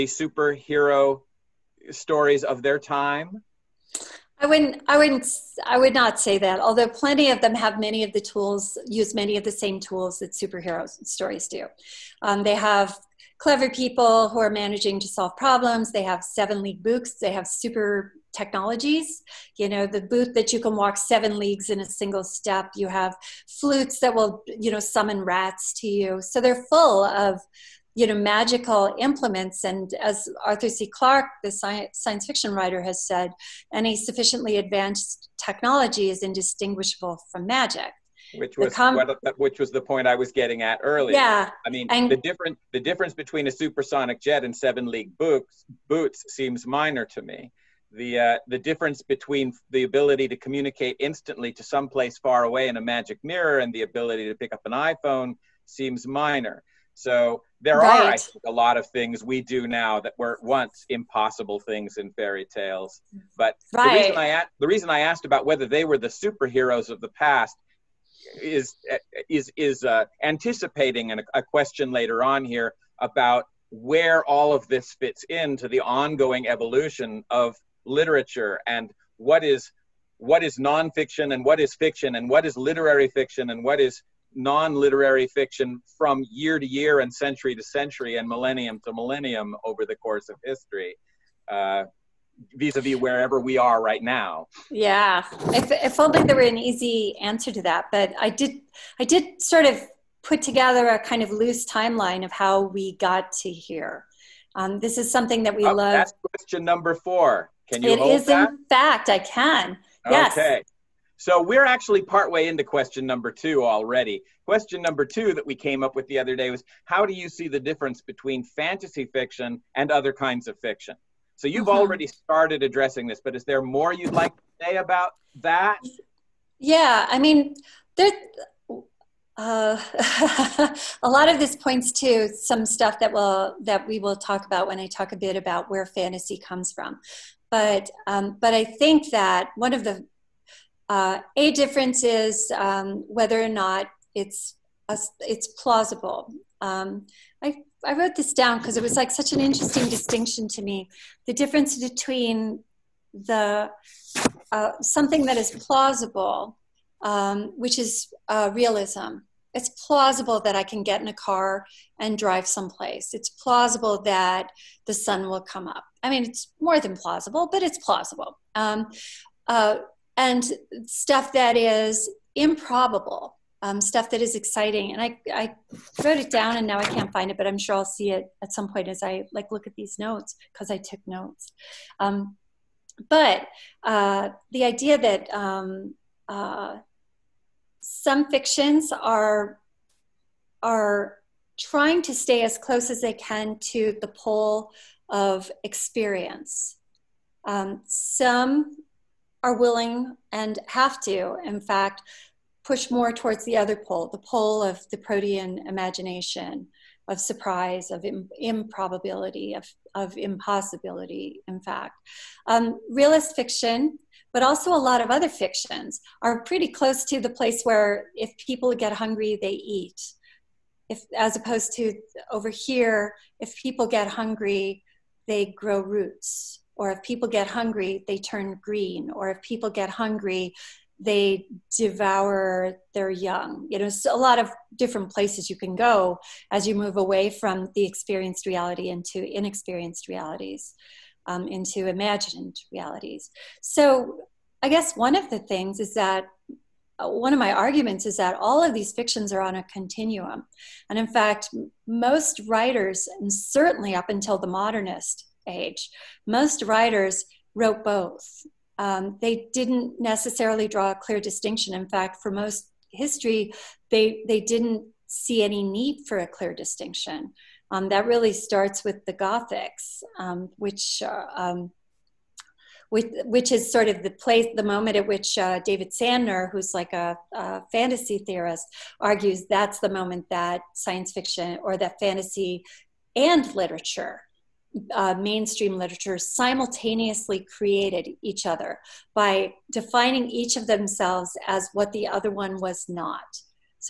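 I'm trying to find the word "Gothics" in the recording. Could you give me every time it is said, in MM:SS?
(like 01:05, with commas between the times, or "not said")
04:29.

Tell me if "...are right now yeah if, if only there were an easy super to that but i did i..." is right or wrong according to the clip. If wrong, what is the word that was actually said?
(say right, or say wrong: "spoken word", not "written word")
wrong: "answer", not "super".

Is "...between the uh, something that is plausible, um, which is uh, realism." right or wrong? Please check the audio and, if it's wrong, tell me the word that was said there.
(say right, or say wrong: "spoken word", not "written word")
right.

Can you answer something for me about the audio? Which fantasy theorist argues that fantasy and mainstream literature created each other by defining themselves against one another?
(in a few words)
David Sandner.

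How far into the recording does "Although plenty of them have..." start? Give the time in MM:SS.
00:06.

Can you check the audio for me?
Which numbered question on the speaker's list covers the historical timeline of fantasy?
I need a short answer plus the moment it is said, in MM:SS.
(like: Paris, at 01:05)
4, at 01:46.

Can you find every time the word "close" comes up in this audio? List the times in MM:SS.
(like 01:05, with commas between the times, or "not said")
03:12, 03:36.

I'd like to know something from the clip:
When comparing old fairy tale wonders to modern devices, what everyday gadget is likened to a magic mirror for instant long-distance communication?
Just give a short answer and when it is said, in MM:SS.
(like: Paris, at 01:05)
iPhone, at 00:54.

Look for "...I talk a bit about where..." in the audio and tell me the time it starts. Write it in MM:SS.
02:14.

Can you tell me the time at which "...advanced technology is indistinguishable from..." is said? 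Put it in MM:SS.
00:34.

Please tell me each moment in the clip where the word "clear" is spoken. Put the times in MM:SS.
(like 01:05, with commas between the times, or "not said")
04:20, 04:26.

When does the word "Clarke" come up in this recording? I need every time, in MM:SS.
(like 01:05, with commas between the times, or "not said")
00:30.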